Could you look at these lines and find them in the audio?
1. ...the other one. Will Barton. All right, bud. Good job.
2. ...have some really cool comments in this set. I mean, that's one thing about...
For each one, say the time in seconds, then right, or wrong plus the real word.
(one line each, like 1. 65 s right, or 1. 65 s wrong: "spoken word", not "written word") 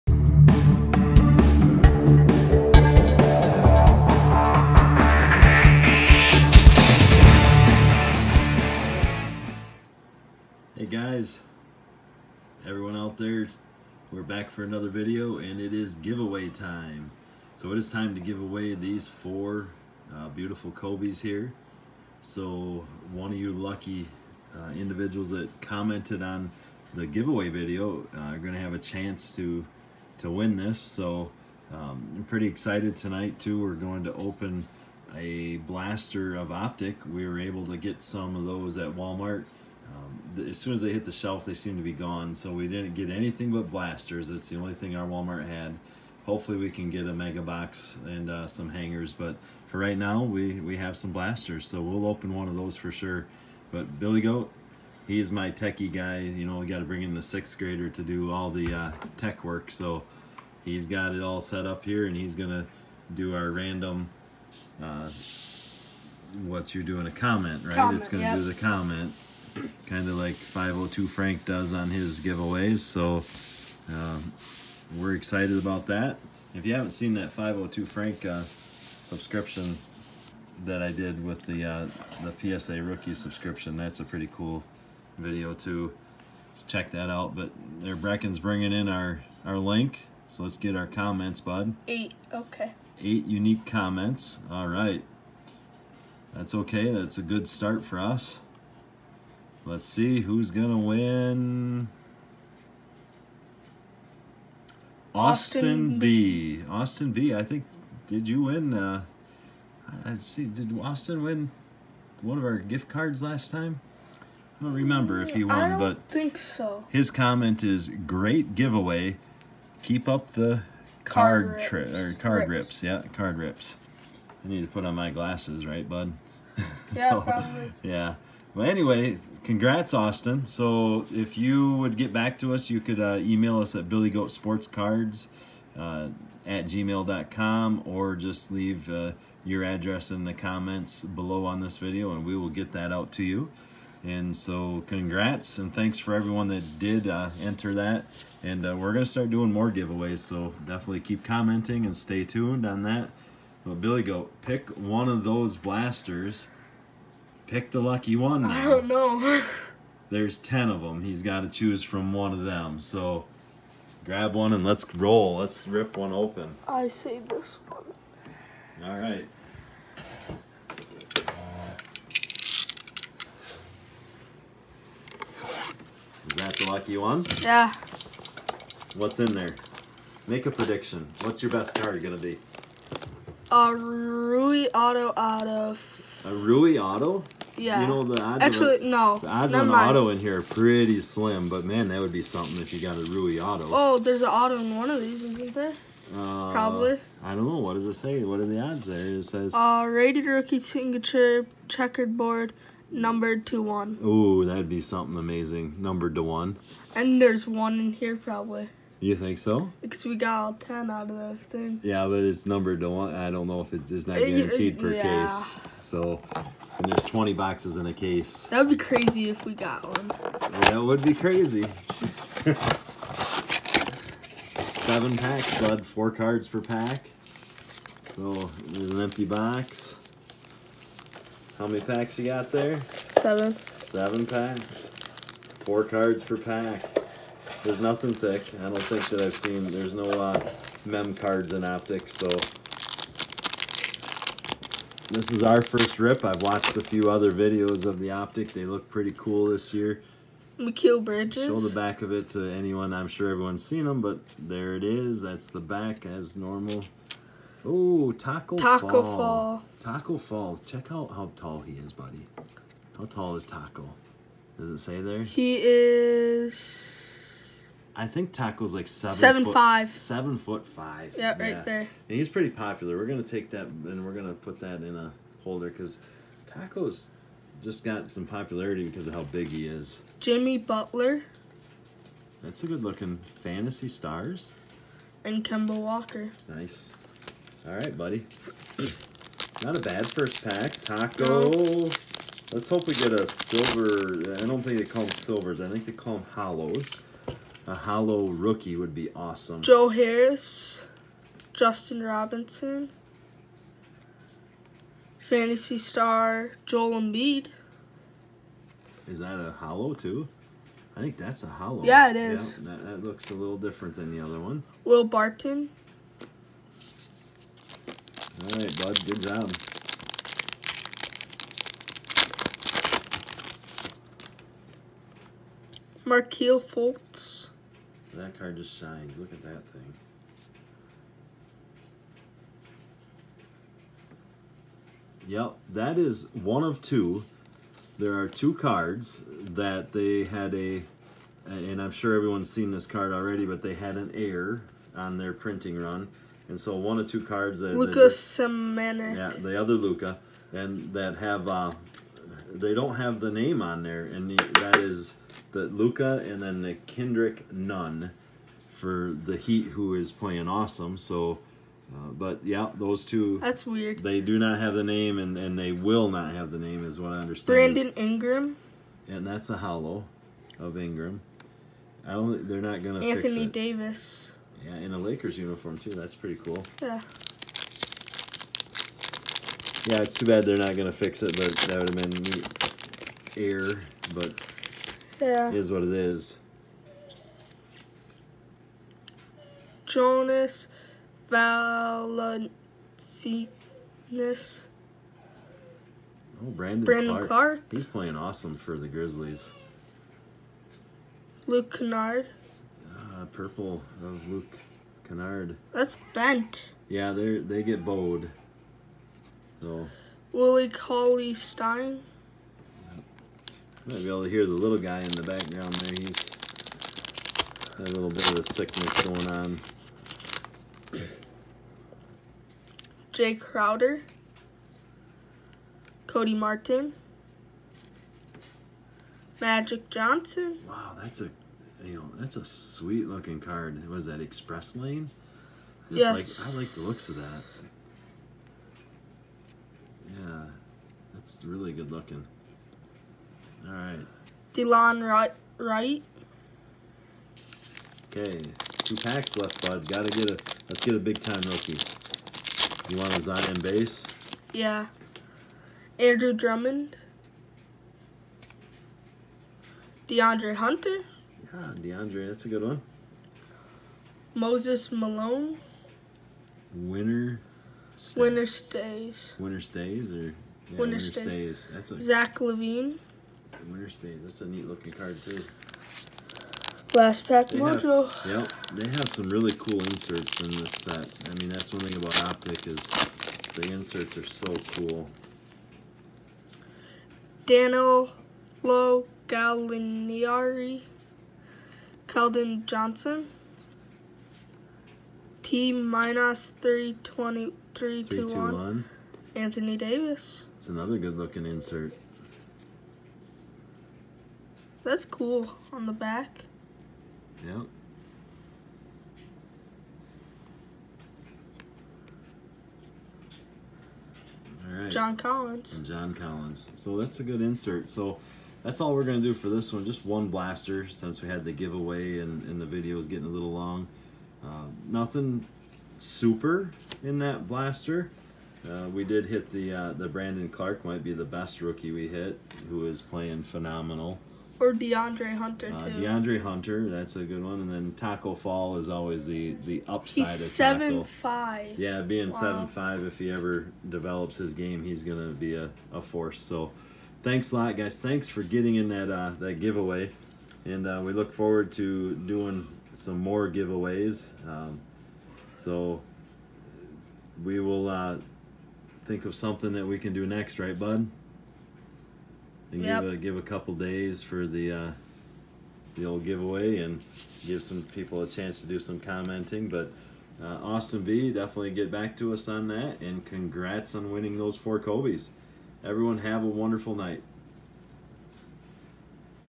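1. 314 s right
2. 478 s wrong: "inserts", not "comments".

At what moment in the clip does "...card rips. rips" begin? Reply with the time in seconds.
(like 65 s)
122 s.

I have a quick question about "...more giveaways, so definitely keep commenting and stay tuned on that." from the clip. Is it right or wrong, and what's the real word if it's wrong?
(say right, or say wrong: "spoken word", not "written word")
right.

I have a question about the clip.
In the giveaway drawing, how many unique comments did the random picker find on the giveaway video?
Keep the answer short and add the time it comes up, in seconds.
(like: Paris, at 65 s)
8, at 93 s.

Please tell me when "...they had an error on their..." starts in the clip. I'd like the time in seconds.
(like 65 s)
343 s.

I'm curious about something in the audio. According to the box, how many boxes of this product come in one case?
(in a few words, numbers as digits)
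20.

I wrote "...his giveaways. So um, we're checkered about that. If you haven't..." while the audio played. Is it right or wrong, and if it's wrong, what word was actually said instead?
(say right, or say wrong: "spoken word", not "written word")
wrong: "excited", not "checkered".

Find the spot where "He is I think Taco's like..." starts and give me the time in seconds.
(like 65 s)
265 s.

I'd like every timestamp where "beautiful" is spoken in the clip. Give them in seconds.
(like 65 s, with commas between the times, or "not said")
20 s.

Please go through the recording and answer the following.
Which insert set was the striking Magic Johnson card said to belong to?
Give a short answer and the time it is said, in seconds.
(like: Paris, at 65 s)
Express Lane, at 434 s.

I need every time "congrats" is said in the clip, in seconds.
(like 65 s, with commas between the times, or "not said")
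129 s, 144 s, 573 s.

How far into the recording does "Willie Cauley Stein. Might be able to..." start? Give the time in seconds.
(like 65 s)
410 s.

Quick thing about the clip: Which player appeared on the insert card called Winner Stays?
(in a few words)
Zach LaVine.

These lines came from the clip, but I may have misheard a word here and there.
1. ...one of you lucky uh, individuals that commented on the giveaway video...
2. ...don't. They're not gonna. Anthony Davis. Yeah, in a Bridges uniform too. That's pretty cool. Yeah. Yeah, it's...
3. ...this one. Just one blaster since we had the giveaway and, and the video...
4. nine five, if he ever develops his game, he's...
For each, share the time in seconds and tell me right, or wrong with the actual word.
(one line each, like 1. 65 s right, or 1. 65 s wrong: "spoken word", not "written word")
1. 23 s right
2. 372 s wrong: "Lakers", not "Bridges"
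3. 519 s right
4. 542 s wrong: "seven", not "nine".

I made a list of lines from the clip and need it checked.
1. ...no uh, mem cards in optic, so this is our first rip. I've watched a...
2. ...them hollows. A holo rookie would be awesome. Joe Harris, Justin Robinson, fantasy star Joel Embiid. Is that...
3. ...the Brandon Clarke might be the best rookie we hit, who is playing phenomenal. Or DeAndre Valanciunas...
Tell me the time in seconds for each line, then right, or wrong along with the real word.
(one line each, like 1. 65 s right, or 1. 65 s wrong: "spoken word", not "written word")
1. 239 s right
2. 296 s right
3. 529 s wrong: "Hunter", not "Valanciunas".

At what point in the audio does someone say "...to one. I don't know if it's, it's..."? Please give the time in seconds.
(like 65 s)
212 s.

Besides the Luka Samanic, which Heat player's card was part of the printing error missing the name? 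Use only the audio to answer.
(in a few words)
Kendrick Nunn.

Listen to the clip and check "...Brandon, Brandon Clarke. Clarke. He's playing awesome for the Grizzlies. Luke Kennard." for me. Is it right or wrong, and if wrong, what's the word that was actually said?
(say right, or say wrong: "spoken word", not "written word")
right.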